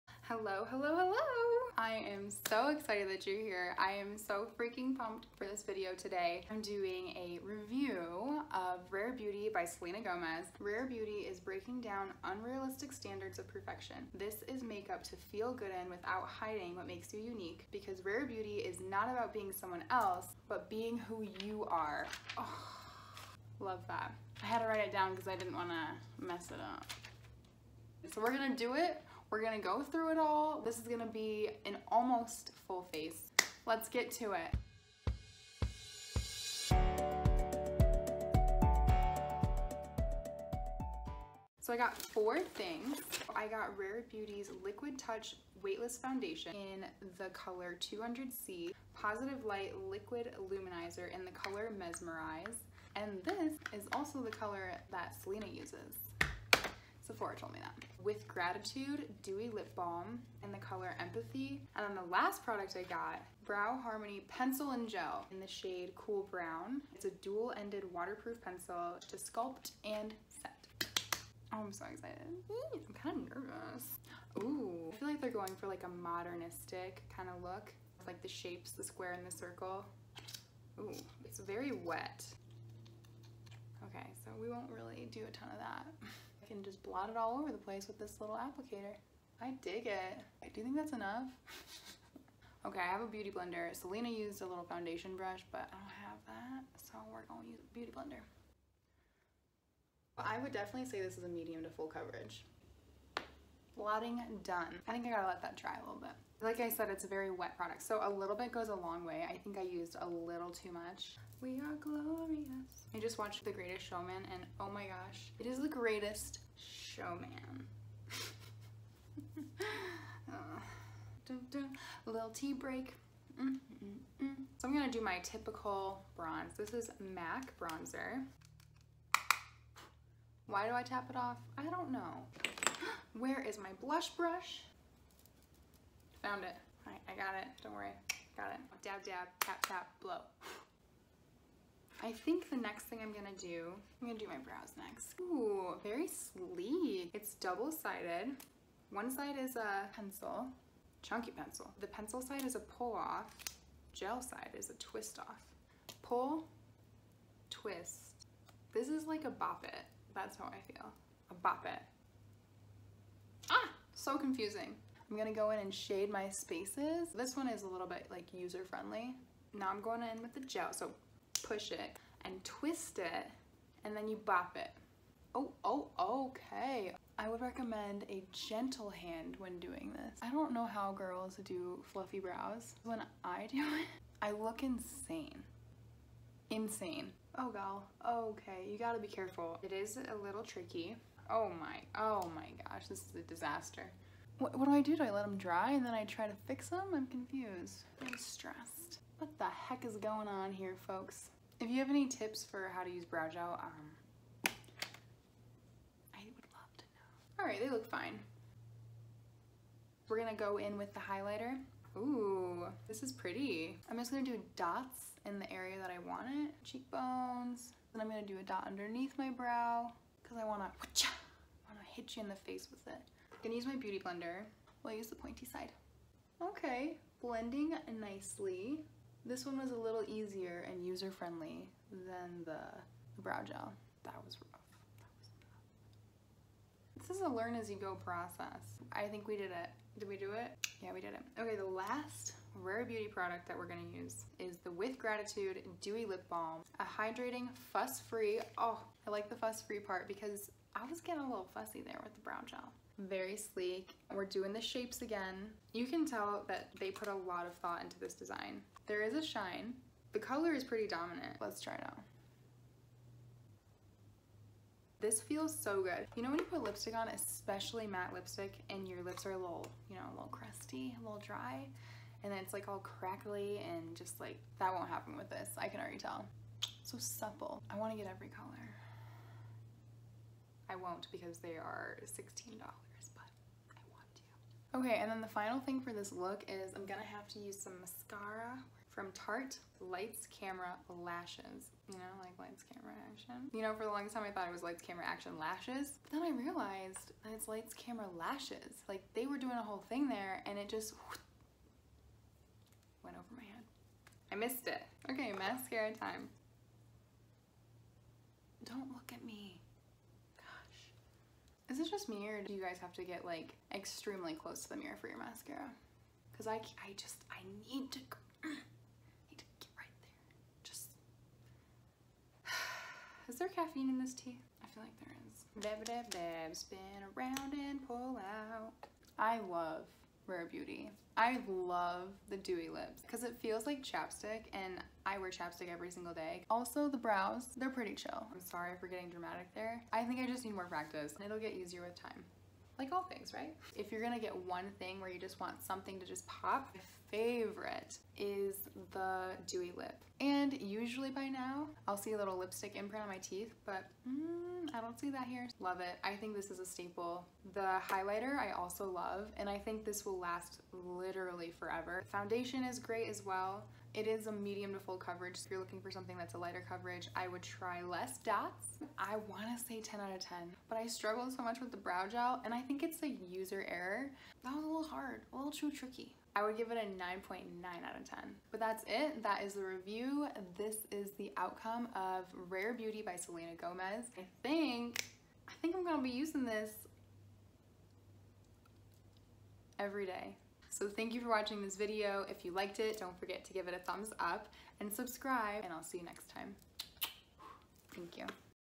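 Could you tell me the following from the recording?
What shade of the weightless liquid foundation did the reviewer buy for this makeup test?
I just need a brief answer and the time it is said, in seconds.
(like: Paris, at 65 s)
200C, at 47 s.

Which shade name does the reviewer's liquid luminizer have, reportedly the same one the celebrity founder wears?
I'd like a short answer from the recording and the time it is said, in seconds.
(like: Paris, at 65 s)
Mesmerize, at 51 s.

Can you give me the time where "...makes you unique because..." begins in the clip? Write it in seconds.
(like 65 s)
16 s.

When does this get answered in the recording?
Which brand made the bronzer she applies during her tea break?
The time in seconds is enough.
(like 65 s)
126 s.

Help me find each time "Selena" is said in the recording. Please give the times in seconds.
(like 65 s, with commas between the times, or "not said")
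9 s, 55 s, 93 s, 383 s.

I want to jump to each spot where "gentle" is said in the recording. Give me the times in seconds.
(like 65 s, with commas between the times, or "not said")
178 s.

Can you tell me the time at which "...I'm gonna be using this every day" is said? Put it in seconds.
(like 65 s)
385 s.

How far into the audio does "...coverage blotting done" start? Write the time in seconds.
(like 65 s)
101 s.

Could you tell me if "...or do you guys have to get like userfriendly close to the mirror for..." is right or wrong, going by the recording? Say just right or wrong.
wrong.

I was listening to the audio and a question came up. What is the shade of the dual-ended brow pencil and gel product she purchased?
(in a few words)
Cool Brown.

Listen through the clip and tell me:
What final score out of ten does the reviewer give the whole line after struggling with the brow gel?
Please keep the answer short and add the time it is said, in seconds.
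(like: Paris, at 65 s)
9.9, at 376 s.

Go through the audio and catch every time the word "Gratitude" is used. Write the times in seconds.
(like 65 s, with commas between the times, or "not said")
58 s, 244 s.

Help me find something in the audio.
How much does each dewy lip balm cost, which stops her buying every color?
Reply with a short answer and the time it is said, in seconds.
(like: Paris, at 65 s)
$16, at 282 s.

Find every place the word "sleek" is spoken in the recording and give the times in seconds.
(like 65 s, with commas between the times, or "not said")
146 s, 253 s.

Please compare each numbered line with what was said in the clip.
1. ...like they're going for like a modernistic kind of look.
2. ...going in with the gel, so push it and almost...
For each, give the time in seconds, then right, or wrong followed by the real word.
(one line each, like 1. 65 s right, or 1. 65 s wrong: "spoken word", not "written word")
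1. 75 s right
2. 169 s wrong: "twist", not "almost".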